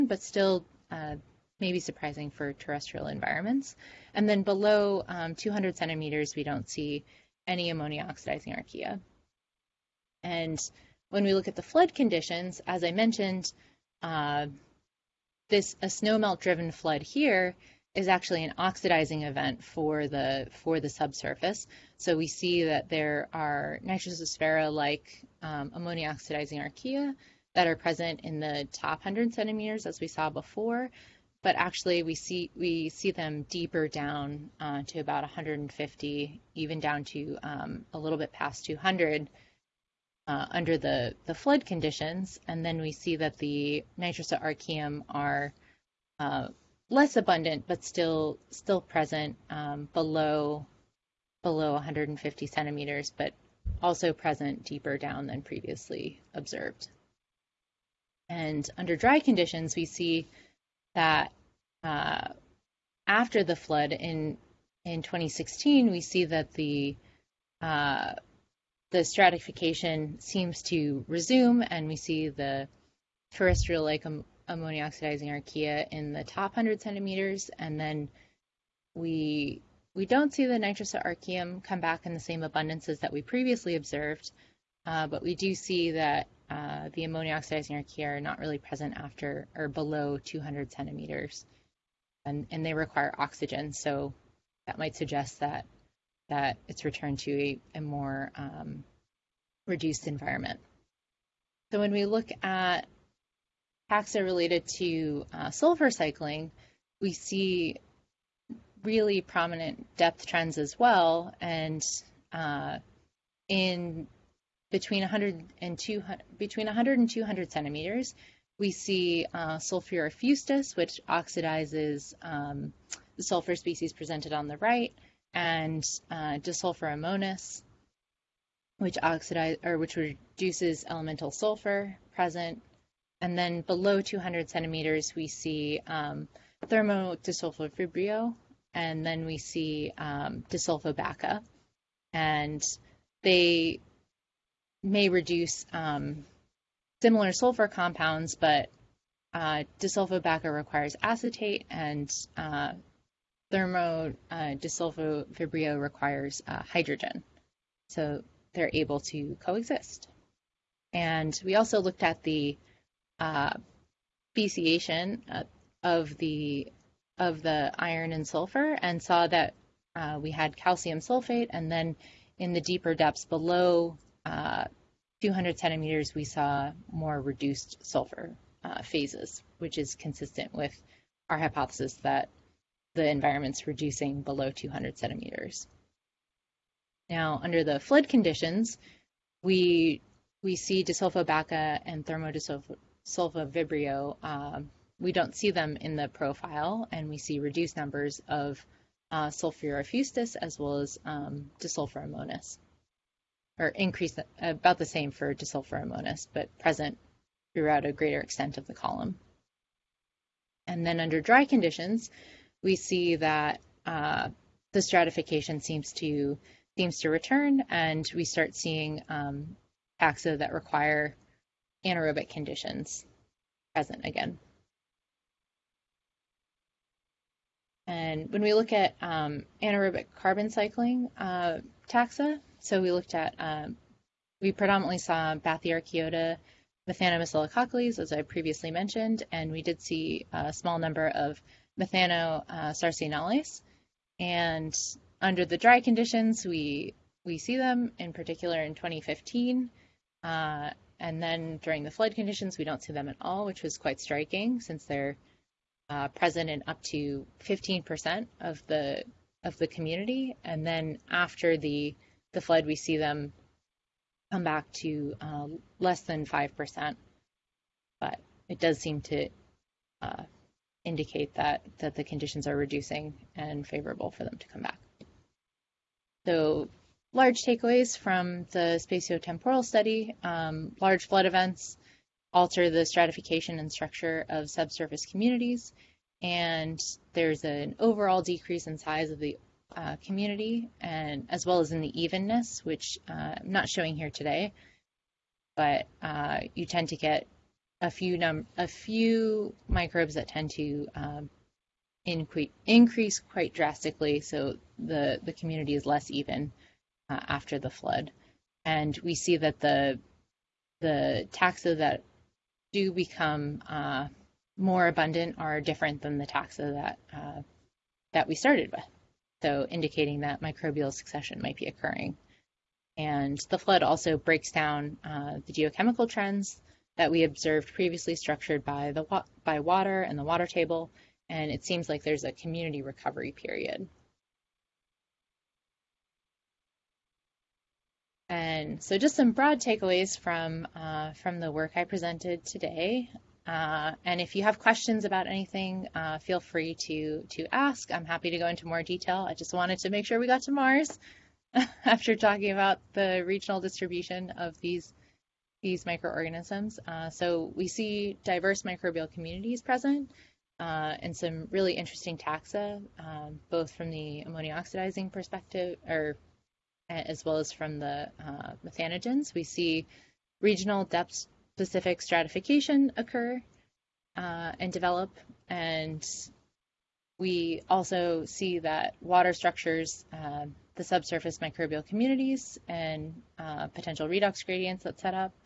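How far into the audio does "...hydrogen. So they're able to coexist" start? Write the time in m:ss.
2:36.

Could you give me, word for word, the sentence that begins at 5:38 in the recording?
And so, just some broad takeaways from uh, from the work I presented today.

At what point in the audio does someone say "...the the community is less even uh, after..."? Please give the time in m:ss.
5:04.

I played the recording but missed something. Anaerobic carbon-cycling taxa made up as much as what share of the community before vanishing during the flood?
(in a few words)
15%.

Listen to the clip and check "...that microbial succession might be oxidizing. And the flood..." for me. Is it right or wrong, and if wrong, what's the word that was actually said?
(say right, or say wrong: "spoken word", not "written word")
wrong: "occurring", not "oxidizing".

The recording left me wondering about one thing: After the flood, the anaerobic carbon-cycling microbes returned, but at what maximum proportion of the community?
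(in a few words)
Less than 5%.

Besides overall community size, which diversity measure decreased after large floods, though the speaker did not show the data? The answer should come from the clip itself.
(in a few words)
Evenness.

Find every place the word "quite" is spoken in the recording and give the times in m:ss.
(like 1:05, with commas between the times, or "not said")
4:13, 5:03.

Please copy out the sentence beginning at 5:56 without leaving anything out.
Uh, so we see diverse microbial communities present.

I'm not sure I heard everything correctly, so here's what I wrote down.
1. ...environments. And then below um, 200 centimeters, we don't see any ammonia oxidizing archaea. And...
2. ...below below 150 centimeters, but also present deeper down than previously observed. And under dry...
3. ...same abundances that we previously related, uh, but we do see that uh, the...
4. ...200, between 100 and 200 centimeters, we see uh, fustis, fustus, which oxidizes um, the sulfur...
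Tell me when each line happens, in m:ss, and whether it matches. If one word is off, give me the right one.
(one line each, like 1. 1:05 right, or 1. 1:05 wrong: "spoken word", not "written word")
1. 0:03 right
2. 0:49 right
3. 1:22 wrong: "observed", not "related"
4. 1:55 right.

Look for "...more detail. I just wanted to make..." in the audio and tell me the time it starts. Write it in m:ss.
5:48.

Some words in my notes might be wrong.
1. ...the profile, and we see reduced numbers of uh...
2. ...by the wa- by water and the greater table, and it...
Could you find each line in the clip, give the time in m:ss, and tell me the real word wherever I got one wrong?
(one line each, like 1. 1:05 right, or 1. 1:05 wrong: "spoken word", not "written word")
1. 3:15 right
2. 5:28 wrong: "water", not "greater".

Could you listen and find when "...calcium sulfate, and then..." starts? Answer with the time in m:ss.
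2:50.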